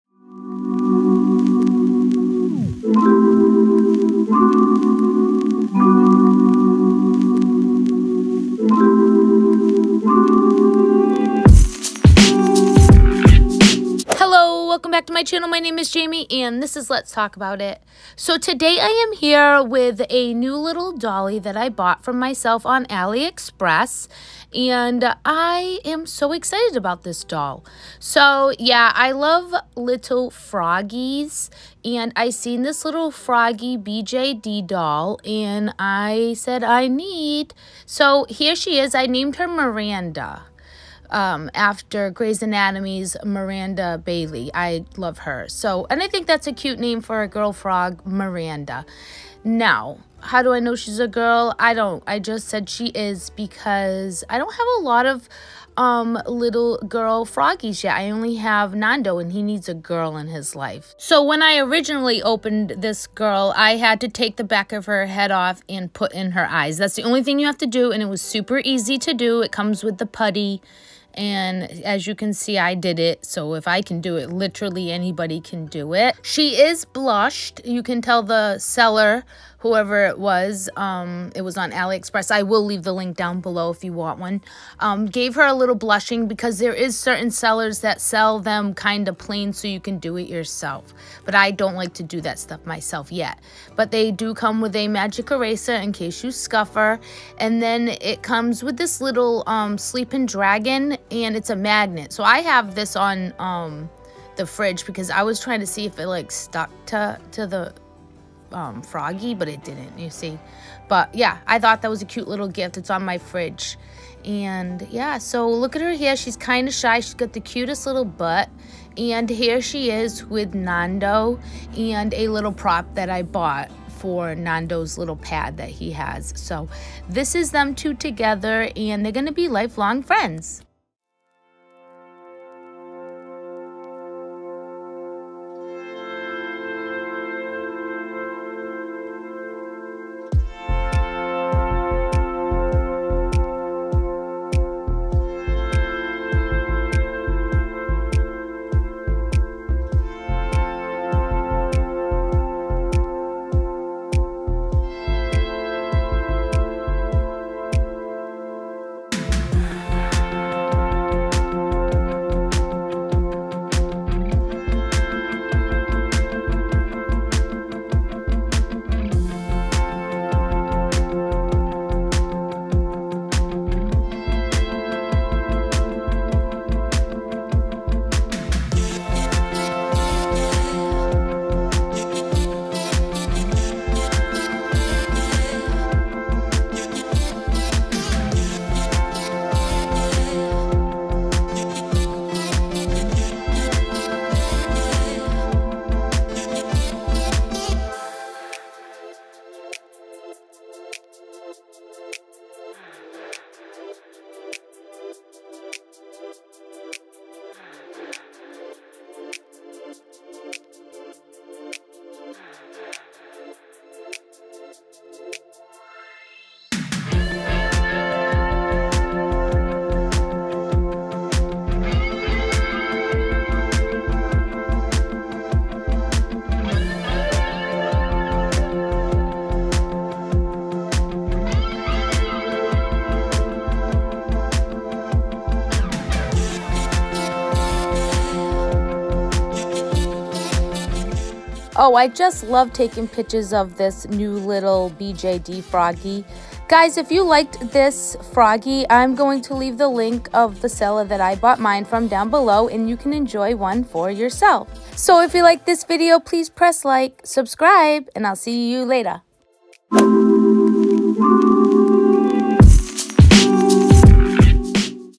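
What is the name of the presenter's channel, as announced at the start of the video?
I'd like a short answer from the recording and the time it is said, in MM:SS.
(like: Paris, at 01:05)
Let's Talk About It, at 00:16.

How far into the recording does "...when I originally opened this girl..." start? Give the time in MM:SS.
01:01.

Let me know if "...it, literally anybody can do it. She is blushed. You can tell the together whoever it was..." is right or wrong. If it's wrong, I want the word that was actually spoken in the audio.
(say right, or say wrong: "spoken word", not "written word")
wrong: "seller", not "together".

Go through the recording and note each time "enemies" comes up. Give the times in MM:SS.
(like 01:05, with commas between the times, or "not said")
not said.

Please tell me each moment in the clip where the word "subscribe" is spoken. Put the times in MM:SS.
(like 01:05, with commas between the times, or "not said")
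04:17.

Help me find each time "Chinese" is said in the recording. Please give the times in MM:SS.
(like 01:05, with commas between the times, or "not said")
not said.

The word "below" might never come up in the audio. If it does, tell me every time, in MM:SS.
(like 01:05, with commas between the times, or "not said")
01:23, 04:12.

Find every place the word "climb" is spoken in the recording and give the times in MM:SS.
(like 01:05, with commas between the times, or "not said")
not said.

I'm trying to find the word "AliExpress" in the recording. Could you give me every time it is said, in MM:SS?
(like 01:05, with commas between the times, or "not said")
00:22, 01:21.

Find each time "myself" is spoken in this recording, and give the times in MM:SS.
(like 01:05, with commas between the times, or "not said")
00:22, 01:32.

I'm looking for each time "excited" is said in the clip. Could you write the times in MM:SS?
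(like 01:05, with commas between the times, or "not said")
00:26.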